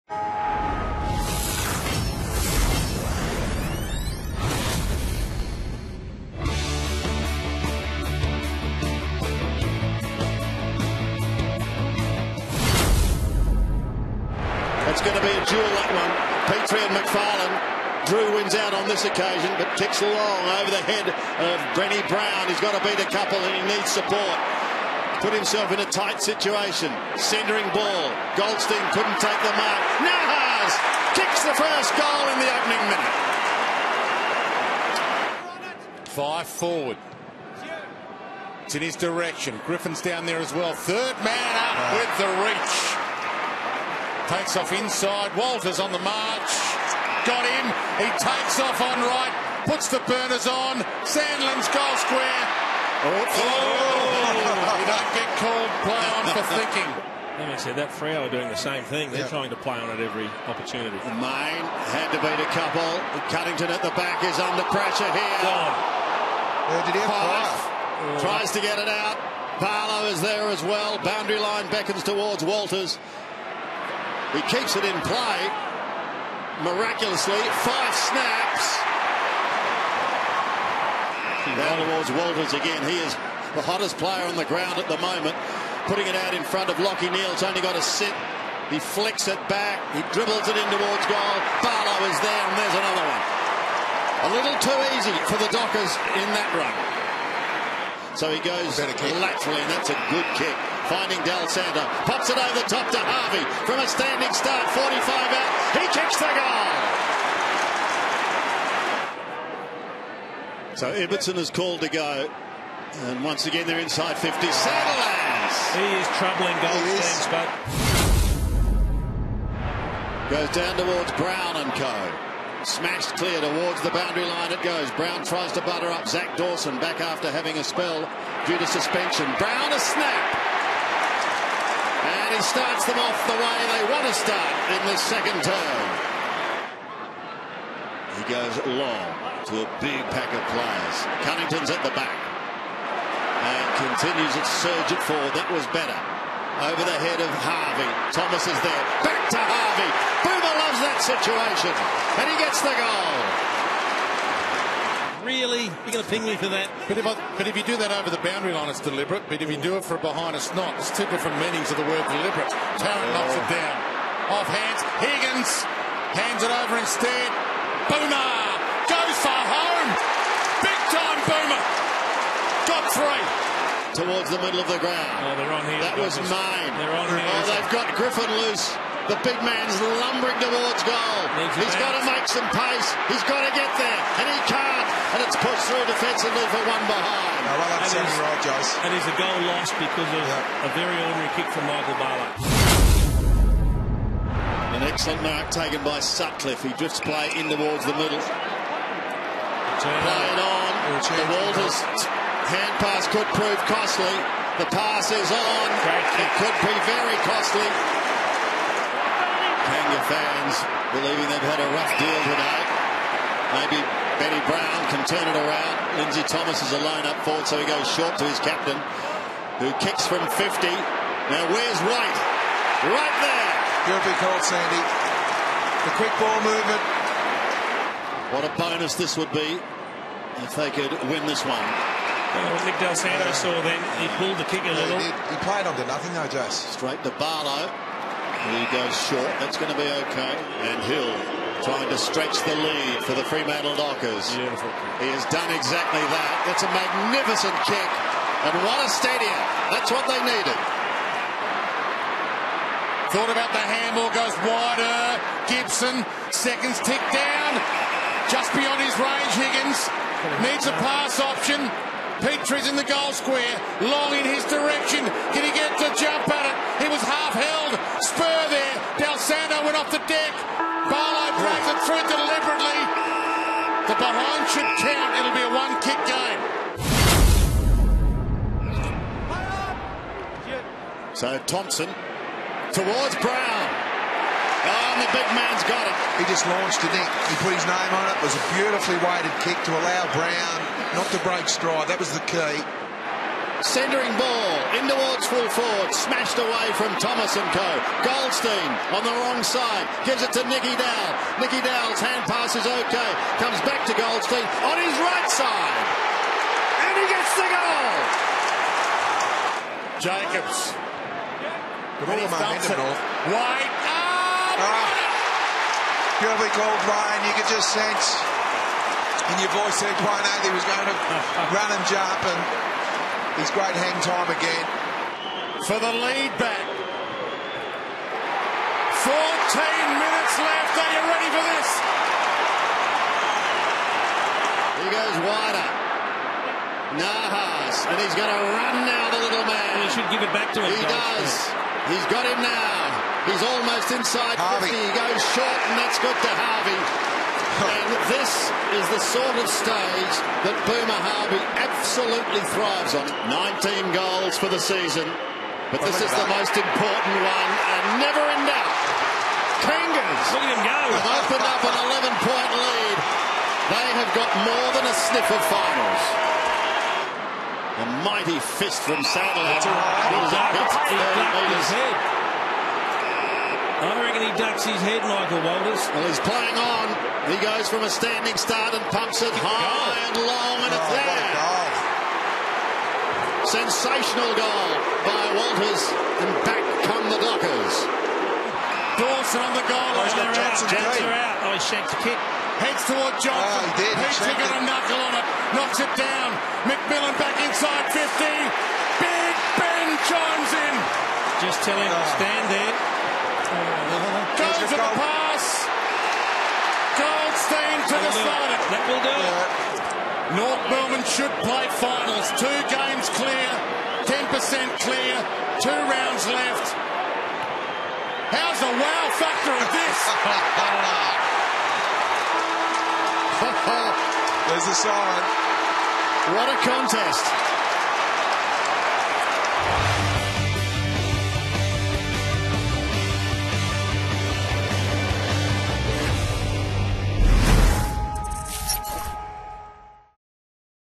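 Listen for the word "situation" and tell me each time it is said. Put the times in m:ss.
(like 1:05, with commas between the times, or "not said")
0:26, 2:30.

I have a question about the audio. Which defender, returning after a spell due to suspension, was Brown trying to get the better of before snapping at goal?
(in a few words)
Zac Dawson.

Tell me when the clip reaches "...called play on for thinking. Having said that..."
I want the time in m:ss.
0:55.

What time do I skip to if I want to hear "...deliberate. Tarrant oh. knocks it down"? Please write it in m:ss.
2:42.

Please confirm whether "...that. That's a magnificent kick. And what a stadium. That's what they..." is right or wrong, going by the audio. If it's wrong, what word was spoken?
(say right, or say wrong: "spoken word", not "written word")
right.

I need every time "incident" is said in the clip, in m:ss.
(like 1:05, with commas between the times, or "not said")
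not said.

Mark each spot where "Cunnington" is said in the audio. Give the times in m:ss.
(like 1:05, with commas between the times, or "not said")
1:03, 2:21.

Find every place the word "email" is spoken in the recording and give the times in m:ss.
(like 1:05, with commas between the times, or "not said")
not said.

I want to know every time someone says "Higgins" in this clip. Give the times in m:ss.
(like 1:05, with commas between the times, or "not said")
2:44, 4:19.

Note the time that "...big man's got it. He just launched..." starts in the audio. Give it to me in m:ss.
4:45.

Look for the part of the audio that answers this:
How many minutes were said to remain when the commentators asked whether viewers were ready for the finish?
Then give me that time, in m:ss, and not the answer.
5:26.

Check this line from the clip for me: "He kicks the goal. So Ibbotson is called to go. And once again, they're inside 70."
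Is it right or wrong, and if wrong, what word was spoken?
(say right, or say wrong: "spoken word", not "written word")
wrong: "50", not "70".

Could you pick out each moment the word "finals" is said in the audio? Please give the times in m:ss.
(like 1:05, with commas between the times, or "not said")
6:05, 6:51.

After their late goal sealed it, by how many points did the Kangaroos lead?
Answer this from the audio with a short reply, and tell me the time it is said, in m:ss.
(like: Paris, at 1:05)
11, at 6:02.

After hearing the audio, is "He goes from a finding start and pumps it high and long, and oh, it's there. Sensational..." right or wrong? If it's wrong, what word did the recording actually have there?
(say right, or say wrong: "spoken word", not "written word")
wrong: "standing", not "finding".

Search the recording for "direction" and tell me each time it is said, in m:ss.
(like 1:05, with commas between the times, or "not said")
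0:38, 4:24.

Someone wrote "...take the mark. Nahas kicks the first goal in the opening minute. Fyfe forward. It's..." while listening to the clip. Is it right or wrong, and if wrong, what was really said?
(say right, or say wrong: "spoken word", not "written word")
right.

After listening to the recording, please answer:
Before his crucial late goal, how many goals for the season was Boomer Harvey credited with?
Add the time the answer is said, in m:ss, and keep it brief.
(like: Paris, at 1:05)
19, at 5:53.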